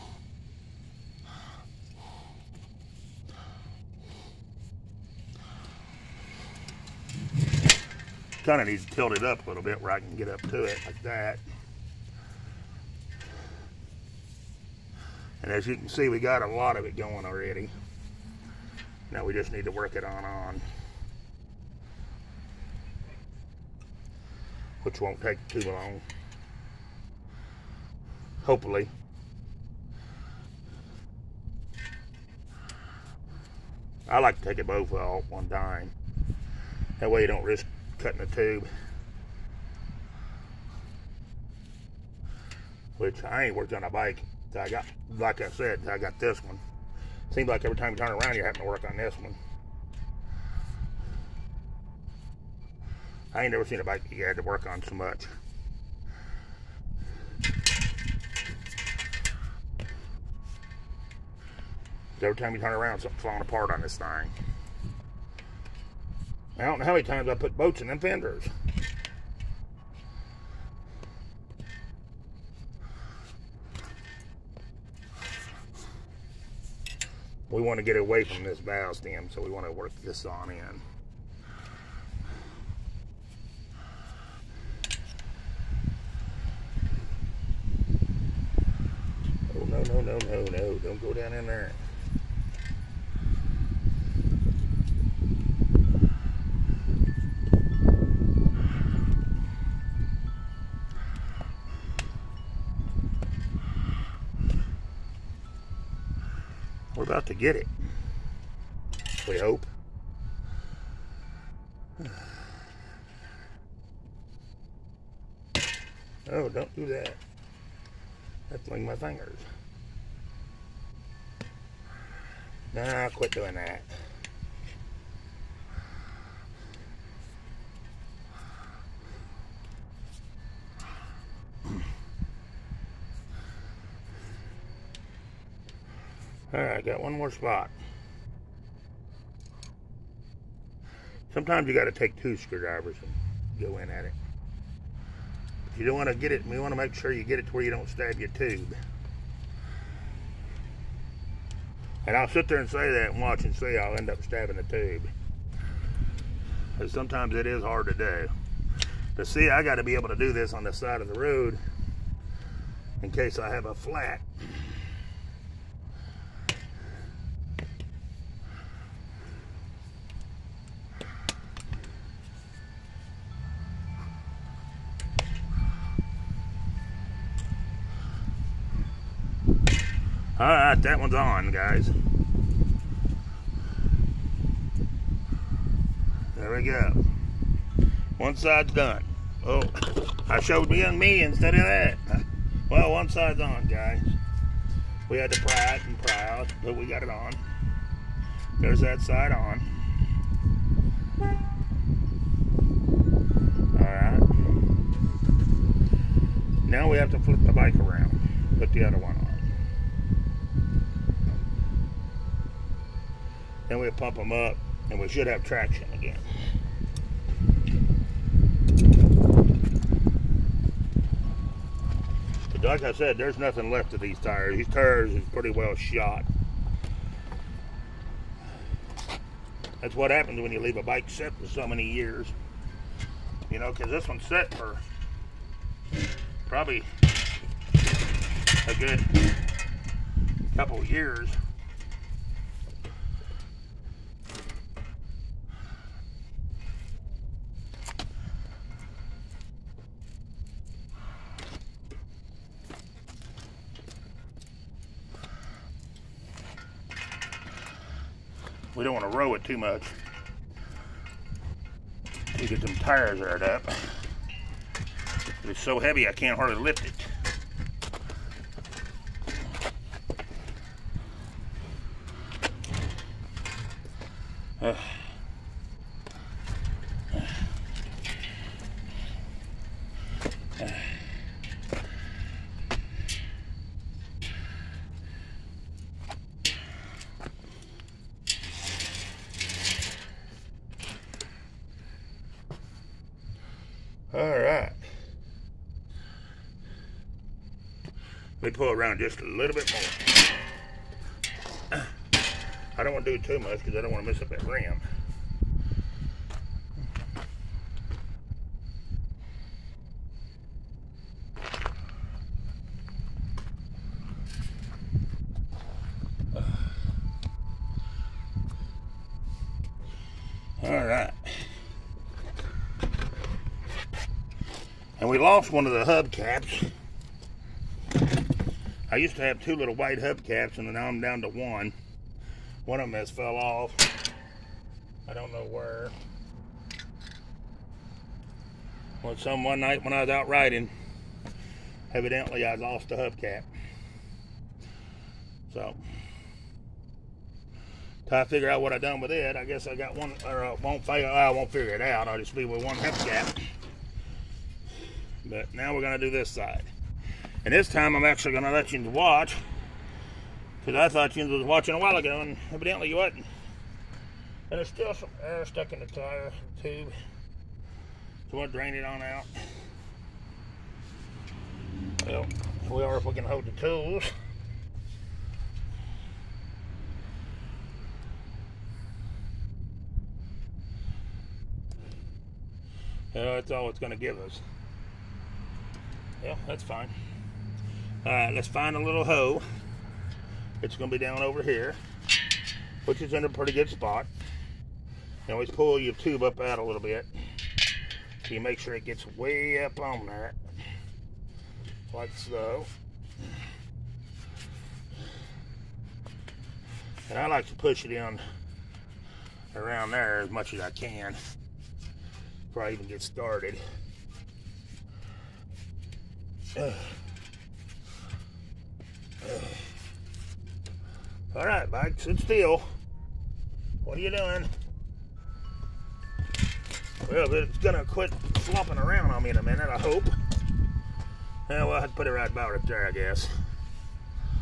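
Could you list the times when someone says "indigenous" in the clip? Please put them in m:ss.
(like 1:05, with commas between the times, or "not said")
not said.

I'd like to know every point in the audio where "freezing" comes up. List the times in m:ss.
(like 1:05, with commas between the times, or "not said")
not said.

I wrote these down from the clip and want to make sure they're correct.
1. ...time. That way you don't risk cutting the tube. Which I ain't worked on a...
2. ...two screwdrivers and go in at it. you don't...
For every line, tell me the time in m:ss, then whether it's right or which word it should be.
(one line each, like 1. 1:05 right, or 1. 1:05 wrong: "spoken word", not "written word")
1. 0:35 right
2. 2:22 right.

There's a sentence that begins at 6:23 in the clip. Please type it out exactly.
that's all it's going to give us.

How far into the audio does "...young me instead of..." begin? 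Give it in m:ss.
3:10.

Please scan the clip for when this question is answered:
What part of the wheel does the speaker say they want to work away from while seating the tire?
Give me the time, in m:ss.
1:18.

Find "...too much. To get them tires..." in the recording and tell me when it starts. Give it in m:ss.
4:19.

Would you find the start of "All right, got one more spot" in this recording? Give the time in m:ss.
2:16.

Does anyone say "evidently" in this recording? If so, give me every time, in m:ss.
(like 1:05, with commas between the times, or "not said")
5:41, 6:02.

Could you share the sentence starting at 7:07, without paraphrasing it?
Well, it's gonna quit flopping around on me in a minute, I hope.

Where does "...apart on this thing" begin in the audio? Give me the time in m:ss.
1:03.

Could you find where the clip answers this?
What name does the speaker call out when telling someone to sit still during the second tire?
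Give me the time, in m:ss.
7:01.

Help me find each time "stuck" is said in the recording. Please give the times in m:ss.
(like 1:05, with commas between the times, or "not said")
6:05.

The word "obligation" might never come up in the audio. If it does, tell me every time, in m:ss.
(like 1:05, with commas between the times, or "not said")
not said.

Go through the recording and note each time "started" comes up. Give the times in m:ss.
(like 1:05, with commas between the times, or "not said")
6:53.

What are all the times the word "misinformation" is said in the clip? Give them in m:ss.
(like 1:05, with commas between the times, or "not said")
not said.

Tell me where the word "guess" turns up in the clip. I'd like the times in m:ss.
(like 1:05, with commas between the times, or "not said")
5:49, 7:12.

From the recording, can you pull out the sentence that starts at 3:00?
All right, that one's on, guys.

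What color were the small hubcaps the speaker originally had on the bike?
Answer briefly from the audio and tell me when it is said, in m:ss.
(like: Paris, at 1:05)
white, at 5:29.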